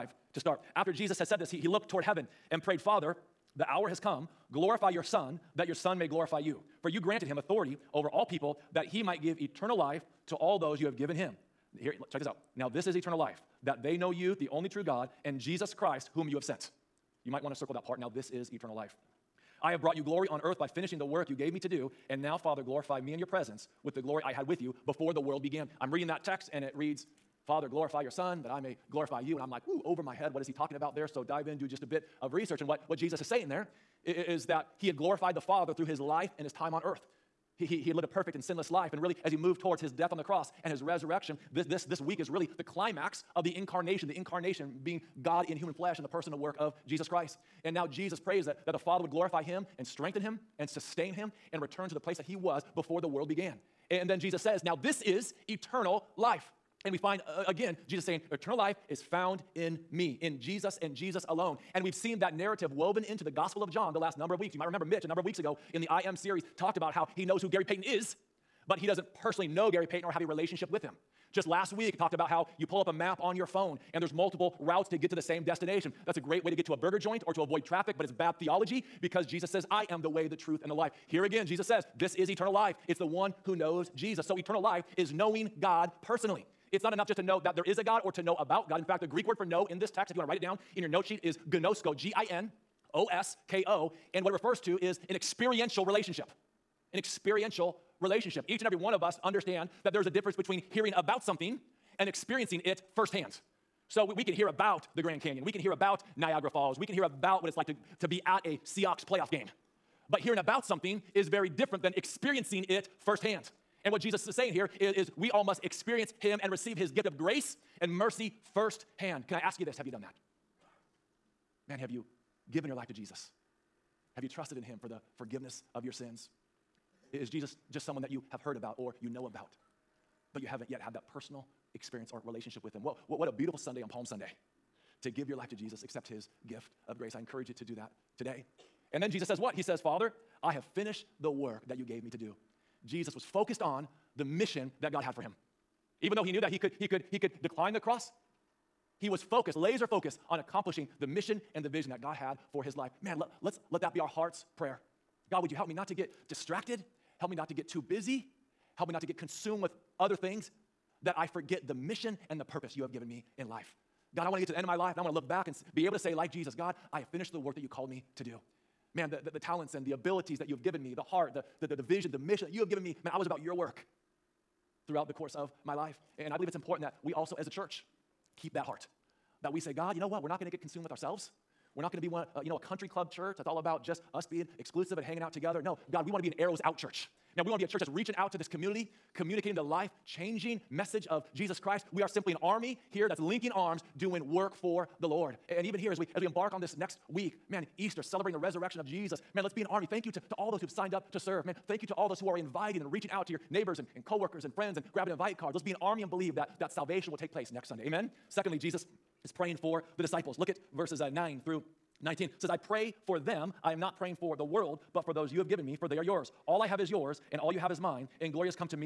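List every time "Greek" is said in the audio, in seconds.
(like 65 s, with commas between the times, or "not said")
89 s.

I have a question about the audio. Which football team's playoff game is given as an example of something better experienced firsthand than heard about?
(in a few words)
Seahawks.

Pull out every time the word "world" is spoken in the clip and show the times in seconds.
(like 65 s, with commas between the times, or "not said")
25 s, 53 s, 214 s.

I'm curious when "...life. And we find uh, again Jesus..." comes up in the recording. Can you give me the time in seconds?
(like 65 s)
56 s.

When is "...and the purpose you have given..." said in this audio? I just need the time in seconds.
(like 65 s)
162 s.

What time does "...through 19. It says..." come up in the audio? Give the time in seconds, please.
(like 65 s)
211 s.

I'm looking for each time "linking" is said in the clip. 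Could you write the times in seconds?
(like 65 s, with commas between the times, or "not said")
193 s.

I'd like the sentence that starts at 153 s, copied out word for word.
Man, let, let's let that be our heart's prayer.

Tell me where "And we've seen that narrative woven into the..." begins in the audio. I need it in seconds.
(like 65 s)
61 s.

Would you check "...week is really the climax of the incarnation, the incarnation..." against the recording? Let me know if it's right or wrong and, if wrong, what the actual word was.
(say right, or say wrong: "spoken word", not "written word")
right.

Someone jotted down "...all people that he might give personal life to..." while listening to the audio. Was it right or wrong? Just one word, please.
wrong.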